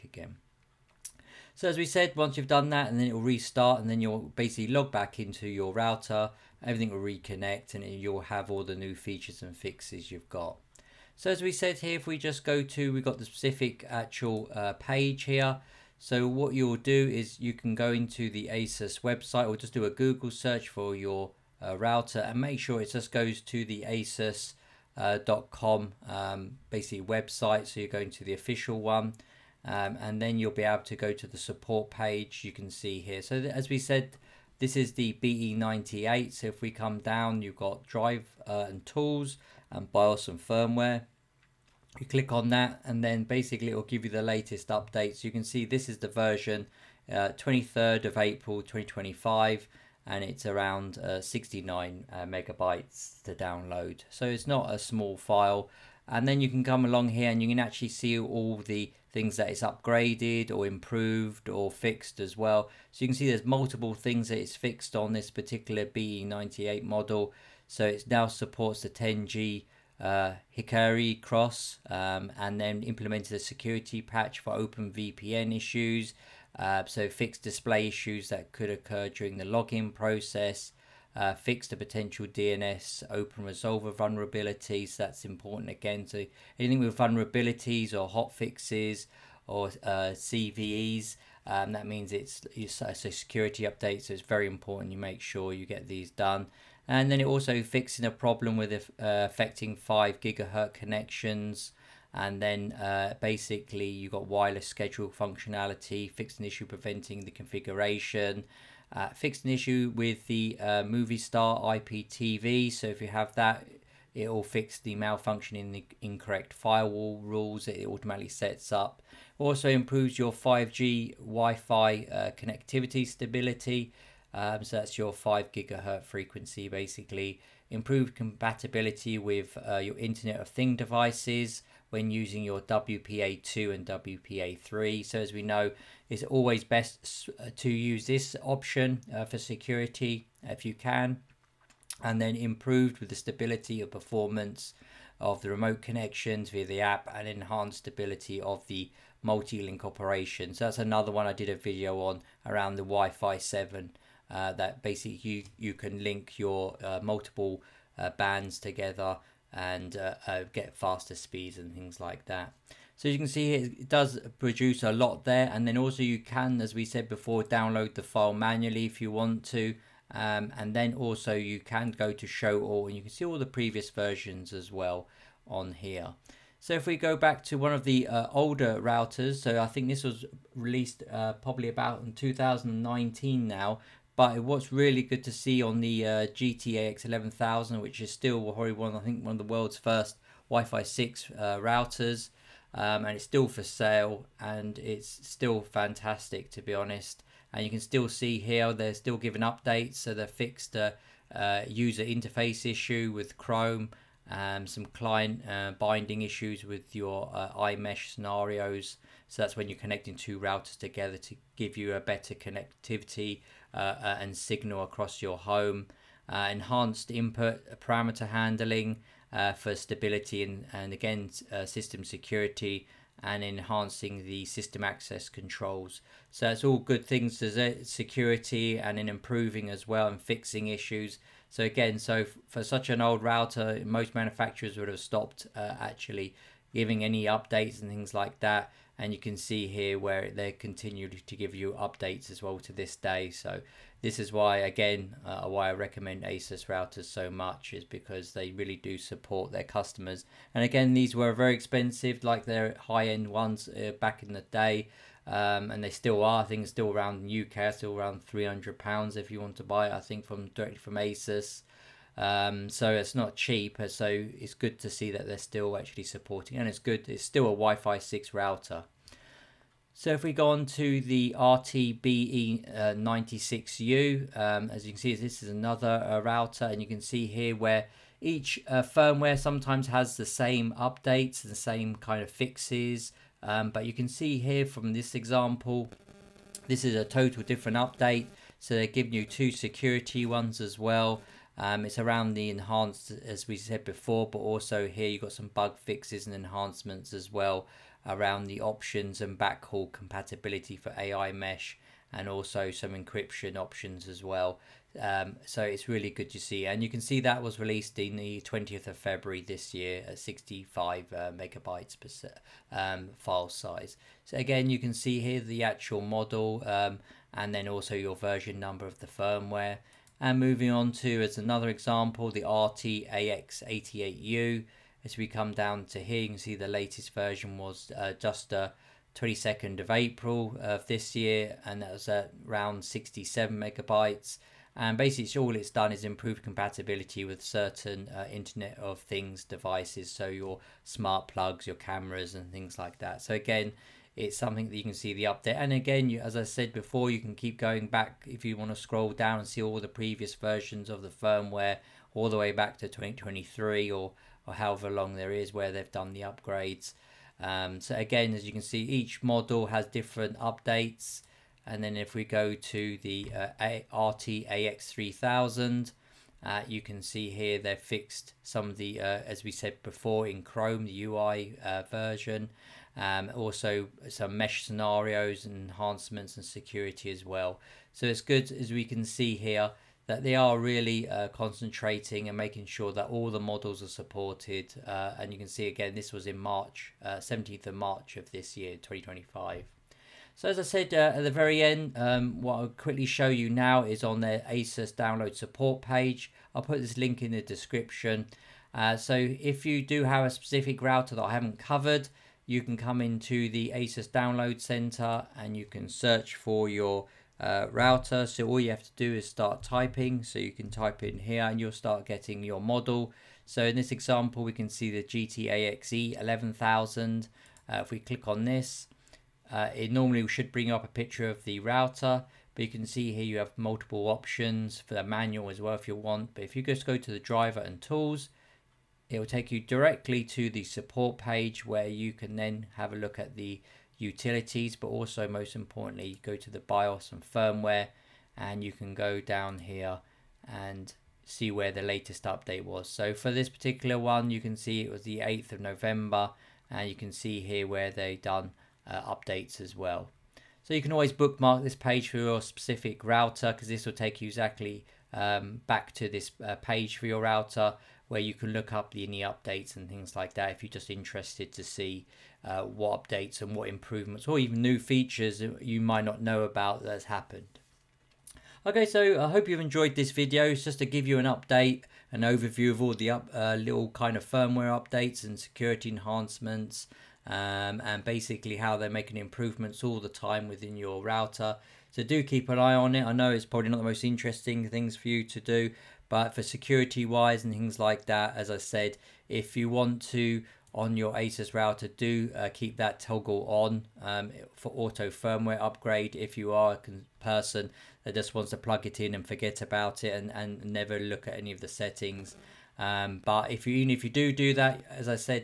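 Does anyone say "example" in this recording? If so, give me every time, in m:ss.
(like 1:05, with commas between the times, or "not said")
4:45, 5:21, 6:53.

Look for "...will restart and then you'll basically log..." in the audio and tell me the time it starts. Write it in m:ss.
0:03.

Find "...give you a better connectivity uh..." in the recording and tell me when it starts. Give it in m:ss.
3:31.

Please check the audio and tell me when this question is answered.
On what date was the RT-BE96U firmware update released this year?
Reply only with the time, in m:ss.
5:08.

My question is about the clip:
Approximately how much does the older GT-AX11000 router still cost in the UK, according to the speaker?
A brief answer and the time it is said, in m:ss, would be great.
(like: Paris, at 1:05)
300 pounds, at 4:18.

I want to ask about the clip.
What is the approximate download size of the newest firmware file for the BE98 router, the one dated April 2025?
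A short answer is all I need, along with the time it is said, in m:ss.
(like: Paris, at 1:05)
69 megabytes, at 0:51.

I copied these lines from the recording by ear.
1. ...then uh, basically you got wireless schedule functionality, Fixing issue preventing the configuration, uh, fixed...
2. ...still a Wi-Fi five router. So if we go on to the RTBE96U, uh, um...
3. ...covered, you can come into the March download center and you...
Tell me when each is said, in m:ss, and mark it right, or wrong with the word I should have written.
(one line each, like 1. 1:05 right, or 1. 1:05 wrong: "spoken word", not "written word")
1. 1:42 right
2. 4:27 wrong: "six", not "five"
3. 6:41 wrong: "ASUS", not "March".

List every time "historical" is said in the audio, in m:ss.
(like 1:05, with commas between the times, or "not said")
not said.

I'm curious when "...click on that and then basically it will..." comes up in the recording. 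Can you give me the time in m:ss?
0:42.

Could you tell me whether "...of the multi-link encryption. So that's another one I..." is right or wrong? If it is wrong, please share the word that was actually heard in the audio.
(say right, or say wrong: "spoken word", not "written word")
wrong: "operation", not "encryption".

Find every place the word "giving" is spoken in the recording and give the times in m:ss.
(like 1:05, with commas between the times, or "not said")
3:19, 3:56, 4:48.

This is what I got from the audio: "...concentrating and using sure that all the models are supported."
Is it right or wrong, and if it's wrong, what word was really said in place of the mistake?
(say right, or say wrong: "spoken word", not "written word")
wrong: "making", not "using".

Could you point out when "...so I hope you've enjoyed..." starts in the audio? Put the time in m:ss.
7:48.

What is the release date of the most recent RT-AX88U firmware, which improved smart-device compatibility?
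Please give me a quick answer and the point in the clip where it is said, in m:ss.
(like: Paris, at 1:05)
22 April, at 5:29.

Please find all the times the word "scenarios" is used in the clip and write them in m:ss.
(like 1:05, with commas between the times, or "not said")
3:28, 6:14.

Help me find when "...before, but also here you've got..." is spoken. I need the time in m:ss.
4:53.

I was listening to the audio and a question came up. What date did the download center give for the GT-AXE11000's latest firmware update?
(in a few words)
8 November.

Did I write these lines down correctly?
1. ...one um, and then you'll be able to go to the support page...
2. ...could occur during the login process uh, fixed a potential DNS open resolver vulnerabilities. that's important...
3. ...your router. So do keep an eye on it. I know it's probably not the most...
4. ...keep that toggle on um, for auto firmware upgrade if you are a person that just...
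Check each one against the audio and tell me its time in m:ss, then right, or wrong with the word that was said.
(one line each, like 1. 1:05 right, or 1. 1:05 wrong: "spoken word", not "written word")
1. 0:28 right
2. 1:18 right
3. 8:00 right
4. 8:12 right.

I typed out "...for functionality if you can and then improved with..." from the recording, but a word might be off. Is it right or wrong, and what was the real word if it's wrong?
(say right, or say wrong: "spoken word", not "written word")
wrong: "security", not "functionality".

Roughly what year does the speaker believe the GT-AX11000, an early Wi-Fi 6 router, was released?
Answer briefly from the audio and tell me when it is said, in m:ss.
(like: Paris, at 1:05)
2019, at 3:02.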